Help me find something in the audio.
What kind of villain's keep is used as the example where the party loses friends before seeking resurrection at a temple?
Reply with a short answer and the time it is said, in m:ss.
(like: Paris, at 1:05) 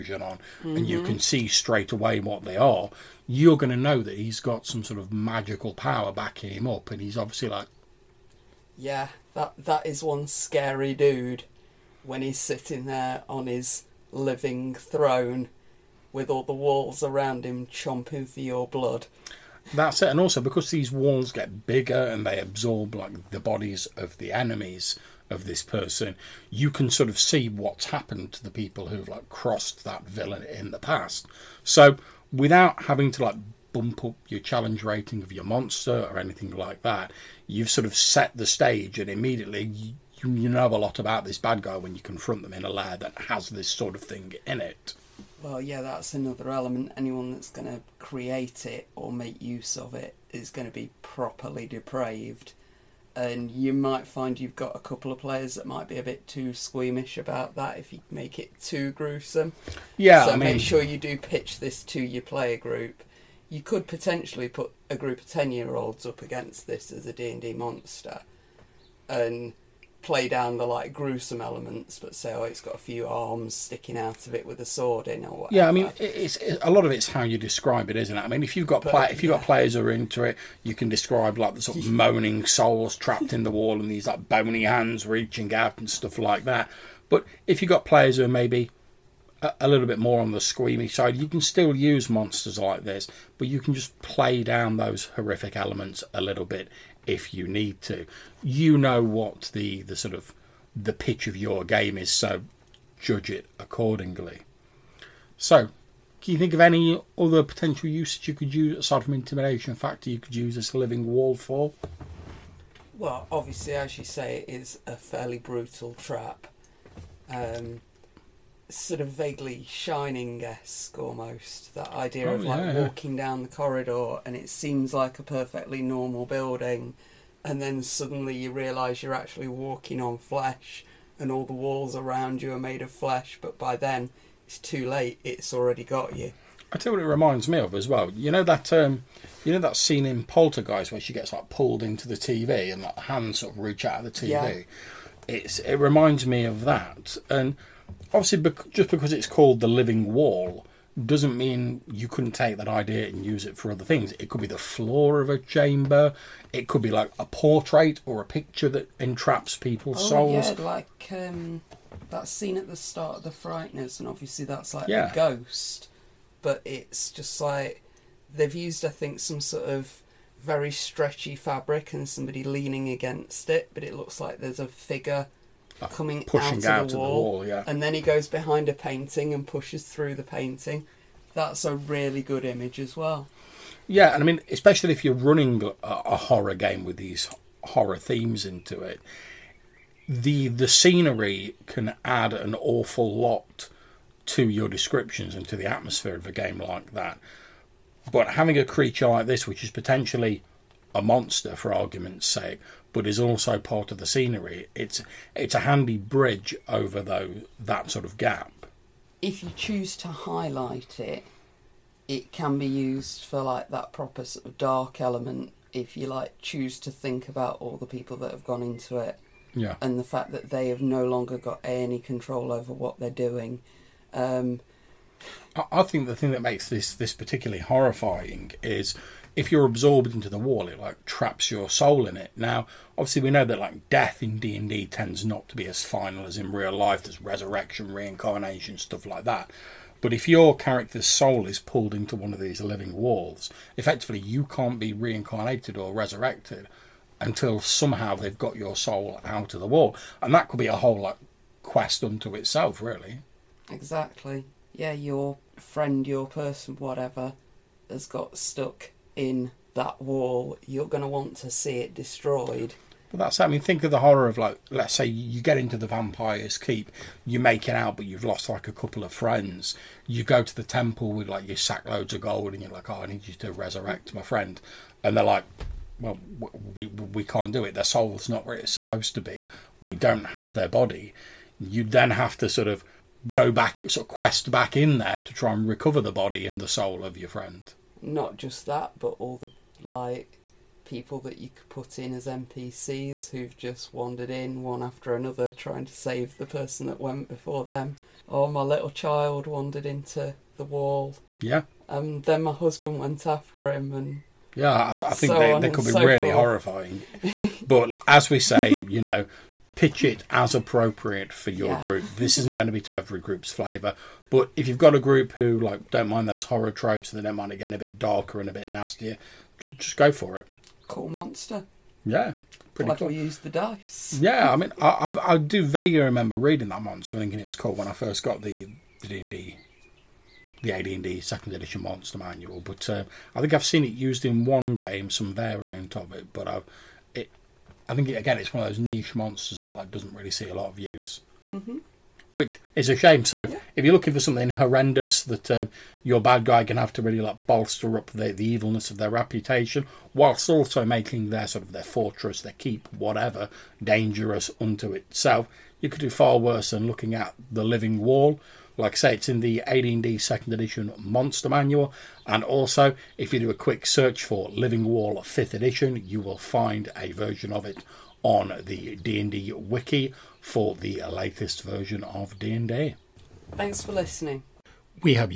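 vampire, at 4:25.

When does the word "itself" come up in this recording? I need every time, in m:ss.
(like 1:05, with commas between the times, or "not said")
4:12, 5:54.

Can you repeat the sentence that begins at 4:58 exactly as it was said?
Or oh, my little child wandered into the wall.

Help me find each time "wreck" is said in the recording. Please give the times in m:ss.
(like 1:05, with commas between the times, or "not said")
not said.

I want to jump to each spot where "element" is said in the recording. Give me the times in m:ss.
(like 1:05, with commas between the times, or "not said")
0:46, 1:11, 1:35, 3:34.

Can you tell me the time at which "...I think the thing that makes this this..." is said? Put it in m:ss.
3:45.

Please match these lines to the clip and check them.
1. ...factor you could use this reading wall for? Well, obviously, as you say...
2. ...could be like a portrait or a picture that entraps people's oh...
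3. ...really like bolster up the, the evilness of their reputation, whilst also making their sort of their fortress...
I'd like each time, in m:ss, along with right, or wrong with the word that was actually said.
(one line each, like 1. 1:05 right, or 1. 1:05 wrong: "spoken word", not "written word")
1. 1:49 wrong: "living", not "reading"
2. 2:36 right
3. 5:47 right.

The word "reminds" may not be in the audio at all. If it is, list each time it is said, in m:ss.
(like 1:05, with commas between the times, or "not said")
2:17, 2:25.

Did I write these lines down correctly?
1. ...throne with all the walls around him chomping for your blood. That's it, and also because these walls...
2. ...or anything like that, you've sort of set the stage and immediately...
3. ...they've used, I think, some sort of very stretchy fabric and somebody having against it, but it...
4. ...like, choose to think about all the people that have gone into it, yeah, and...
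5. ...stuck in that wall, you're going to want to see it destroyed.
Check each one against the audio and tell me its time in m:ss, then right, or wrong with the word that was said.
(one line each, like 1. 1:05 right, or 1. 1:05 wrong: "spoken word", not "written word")
1. 0:14 right
2. 0:36 right
3. 2:48 wrong: "leaning", not "having"
4. 3:36 right
5. 4:18 right.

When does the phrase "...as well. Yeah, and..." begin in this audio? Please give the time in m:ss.
3:02.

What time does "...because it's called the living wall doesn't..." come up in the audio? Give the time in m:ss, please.
2:28.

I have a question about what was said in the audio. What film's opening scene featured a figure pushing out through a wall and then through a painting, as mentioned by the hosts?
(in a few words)
The Frighteners.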